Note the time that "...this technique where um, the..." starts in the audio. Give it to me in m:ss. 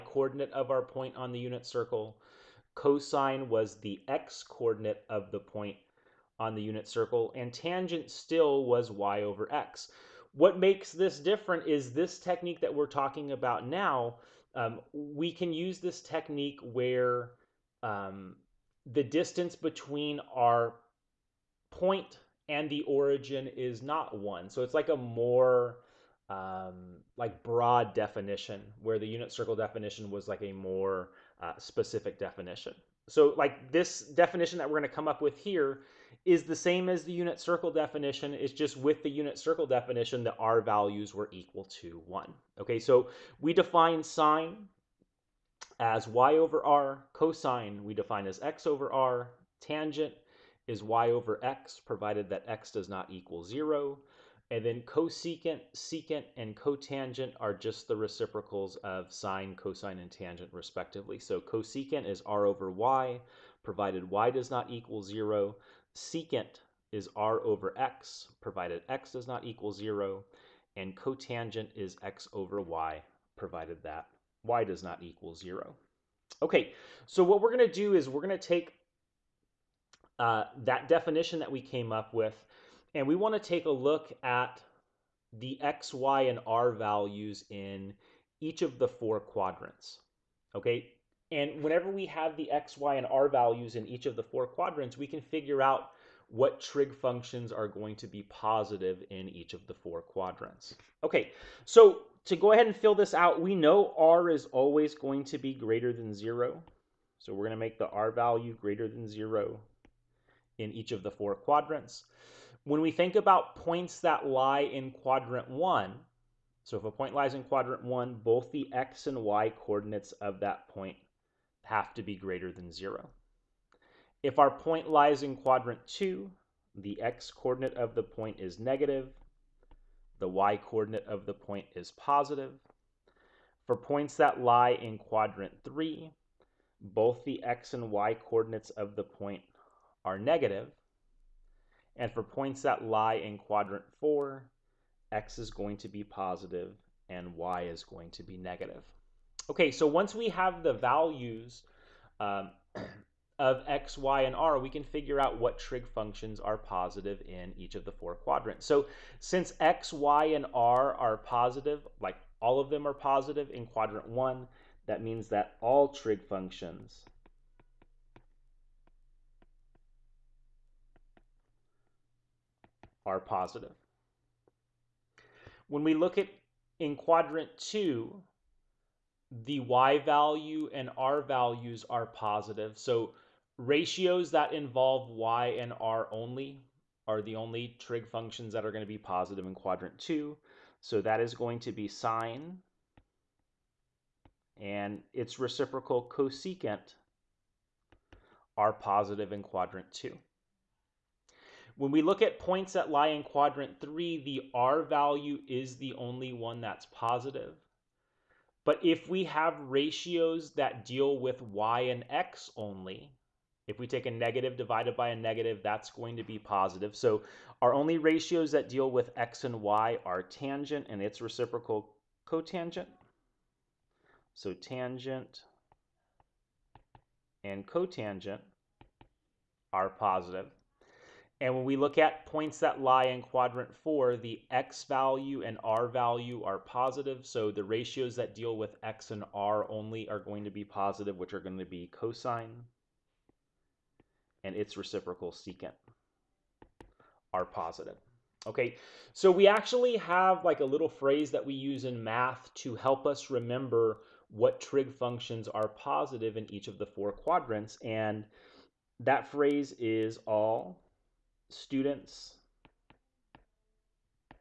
0:15.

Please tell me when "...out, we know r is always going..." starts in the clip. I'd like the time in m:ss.
1:43.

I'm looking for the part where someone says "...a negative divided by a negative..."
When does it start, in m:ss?
3:34.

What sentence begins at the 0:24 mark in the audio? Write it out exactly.
So it's like a more um, like broad definition where the unit circle definition was like a more uh, specific definition.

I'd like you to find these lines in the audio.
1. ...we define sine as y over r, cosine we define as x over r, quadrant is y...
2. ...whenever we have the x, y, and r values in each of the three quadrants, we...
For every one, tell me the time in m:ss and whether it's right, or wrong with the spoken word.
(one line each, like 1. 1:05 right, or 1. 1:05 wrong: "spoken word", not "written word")
1. 0:43 wrong: "tangent", not "quadrant"
2. 1:31 wrong: "four", not "three".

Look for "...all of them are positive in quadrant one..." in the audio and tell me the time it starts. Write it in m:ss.
2:42.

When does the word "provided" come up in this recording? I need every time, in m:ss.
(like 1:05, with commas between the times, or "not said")
0:51, 1:03, 1:08, 1:13.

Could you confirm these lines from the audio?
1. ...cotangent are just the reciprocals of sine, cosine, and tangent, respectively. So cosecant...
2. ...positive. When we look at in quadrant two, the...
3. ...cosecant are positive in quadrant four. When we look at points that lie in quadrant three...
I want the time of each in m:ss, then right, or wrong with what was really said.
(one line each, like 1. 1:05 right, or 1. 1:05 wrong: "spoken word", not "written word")
1. 0:56 right
2. 2:53 right
3. 3:16 wrong: "two", not "four".